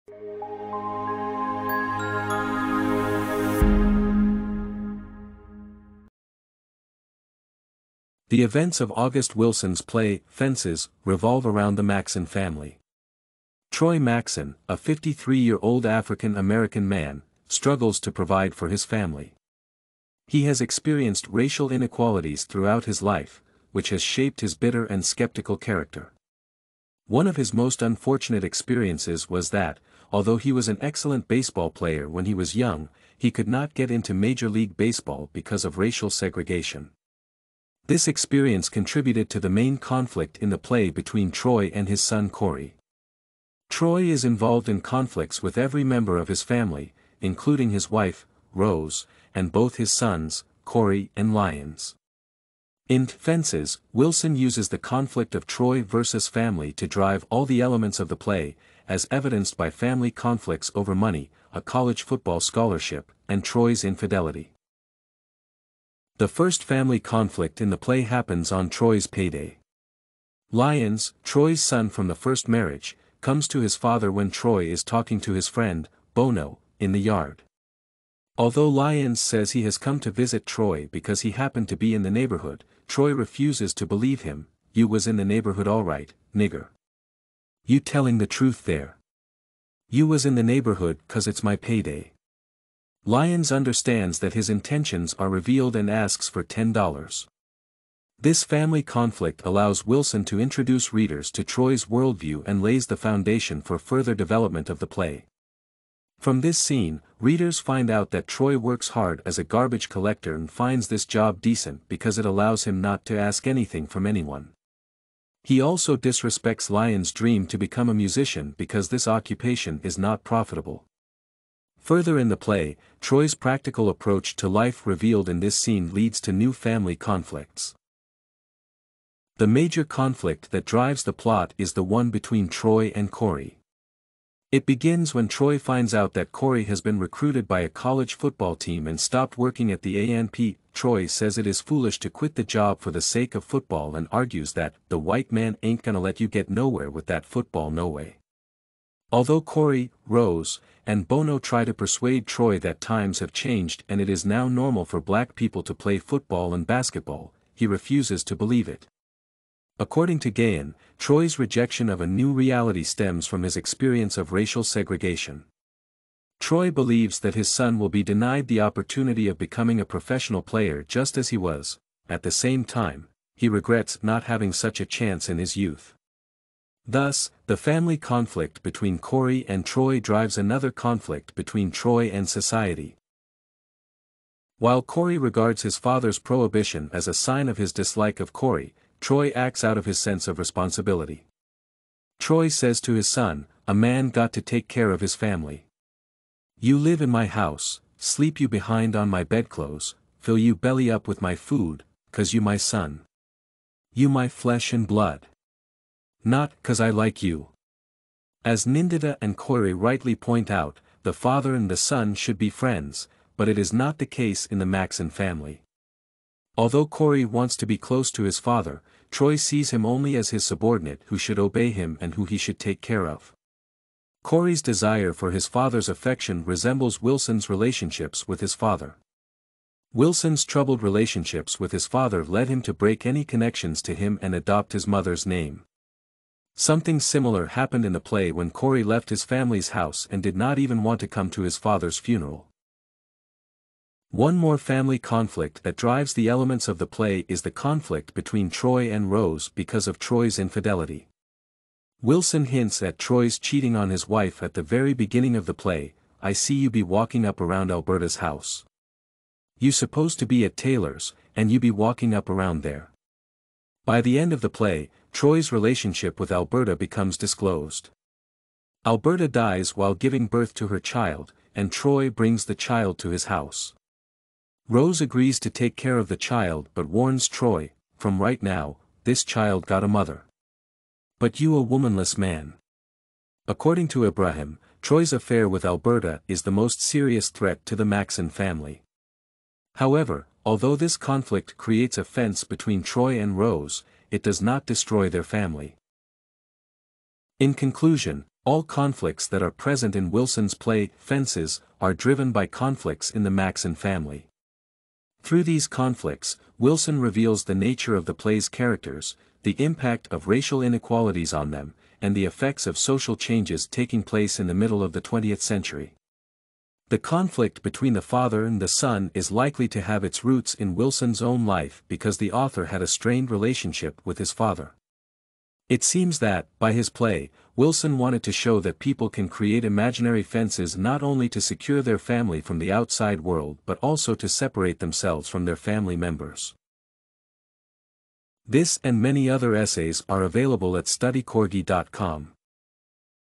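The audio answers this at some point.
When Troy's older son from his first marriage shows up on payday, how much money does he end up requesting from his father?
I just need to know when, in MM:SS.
01:36.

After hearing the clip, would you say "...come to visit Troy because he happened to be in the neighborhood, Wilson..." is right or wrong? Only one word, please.
wrong.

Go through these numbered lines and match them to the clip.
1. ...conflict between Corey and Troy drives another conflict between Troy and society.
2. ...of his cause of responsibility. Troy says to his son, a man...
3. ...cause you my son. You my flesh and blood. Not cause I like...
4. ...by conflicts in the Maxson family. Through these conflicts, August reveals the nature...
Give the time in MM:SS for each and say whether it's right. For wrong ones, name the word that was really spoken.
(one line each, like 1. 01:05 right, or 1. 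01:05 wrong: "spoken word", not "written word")
1. 02:57 right
2. 03:09 wrong: "sense", not "cause"
3. 03:22 right
4. 05:02 wrong: "Wilson", not "August".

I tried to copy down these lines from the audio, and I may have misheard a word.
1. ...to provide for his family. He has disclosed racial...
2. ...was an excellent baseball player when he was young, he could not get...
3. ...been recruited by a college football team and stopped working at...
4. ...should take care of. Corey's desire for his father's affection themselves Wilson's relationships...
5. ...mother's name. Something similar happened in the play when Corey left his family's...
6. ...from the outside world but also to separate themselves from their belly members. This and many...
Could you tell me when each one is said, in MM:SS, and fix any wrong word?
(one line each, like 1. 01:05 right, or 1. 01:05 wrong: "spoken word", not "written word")
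1. 00:17 wrong: "experienced", not "disclosed"
2. 00:30 right
3. 02:16 right
4. 03:42 wrong: "resembles", not "themselves"
5. 03:54 right
6. 05:32 wrong: "family", not "belly".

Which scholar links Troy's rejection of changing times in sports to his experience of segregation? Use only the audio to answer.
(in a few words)
Gayen.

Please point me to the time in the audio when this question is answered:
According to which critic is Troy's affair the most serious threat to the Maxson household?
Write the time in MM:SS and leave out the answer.
04:44.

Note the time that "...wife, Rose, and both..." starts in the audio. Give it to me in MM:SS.
00:47.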